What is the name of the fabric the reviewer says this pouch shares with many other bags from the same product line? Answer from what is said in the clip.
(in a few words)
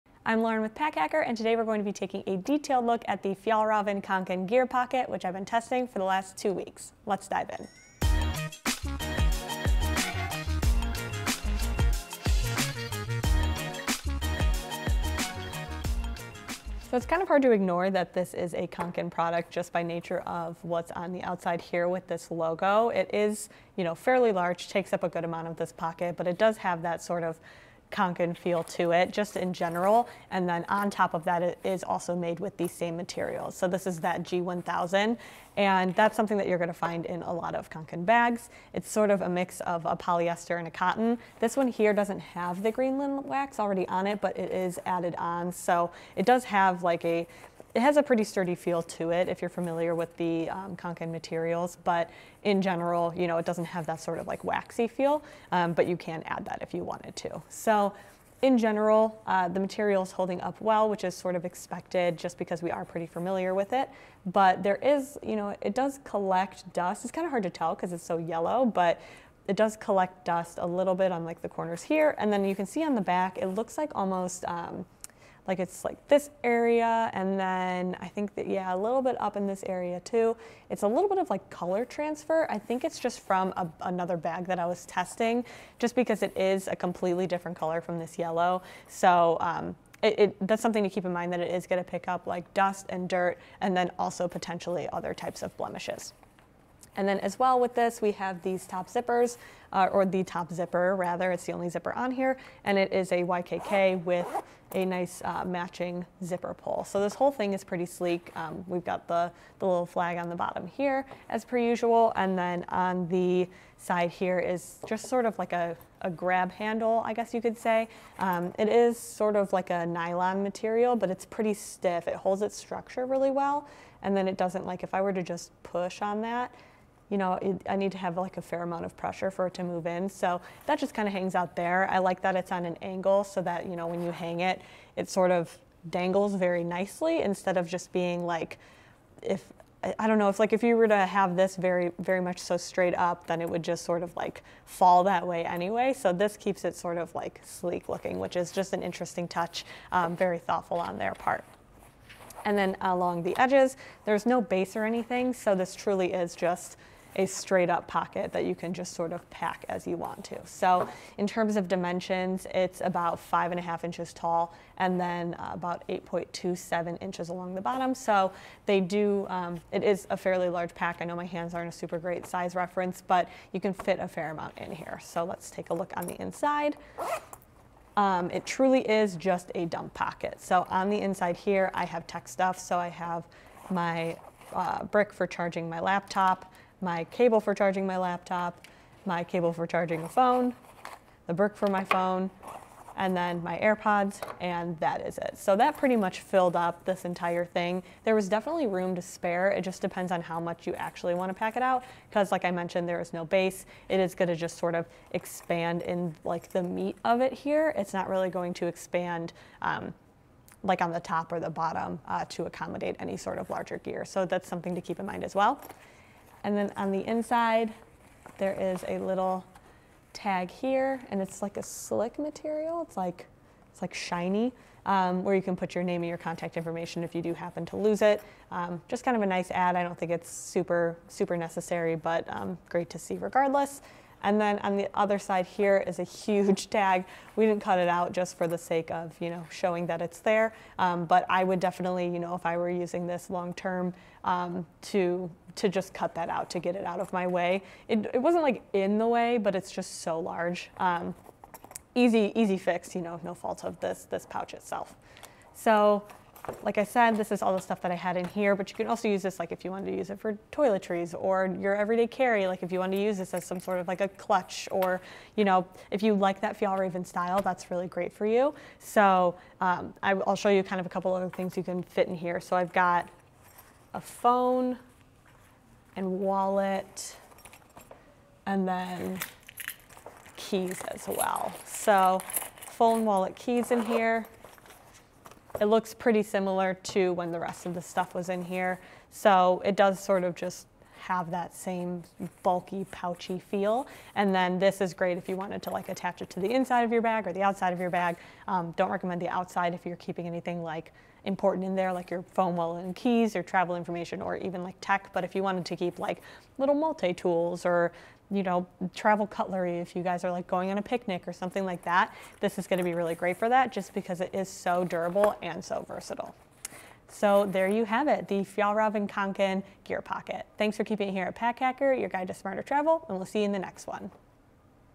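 G1000.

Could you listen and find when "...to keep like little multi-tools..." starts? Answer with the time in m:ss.
5:05.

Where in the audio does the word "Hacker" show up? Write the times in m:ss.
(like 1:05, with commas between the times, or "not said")
0:00, 5:21.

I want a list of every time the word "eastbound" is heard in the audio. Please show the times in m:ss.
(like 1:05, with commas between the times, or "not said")
not said.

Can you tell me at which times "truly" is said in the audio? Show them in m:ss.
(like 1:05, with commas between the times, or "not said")
2:35, 2:58.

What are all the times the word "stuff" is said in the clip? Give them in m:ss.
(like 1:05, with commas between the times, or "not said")
3:02, 4:17, 4:47.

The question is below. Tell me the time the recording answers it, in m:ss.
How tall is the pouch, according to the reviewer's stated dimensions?
2:43.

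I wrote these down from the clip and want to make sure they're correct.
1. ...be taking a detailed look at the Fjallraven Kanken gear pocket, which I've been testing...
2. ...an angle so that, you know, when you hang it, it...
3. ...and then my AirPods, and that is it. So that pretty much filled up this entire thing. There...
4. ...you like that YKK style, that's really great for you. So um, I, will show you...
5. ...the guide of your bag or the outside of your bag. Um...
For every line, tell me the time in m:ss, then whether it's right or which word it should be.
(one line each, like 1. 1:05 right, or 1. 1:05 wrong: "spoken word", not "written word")
1. 0:01 right
2. 2:12 right
3. 3:12 right
4. 4:26 wrong: "Fjallraven", not "YKK"
5. 4:56 wrong: "inside", not "guide".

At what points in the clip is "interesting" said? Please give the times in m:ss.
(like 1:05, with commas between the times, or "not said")
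2:28.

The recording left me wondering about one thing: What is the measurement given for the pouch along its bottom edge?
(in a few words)
8.27 inches.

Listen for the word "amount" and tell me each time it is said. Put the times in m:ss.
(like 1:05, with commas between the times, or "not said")
0:25, 2:08, 2:54.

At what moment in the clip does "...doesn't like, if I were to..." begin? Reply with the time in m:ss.
2:04.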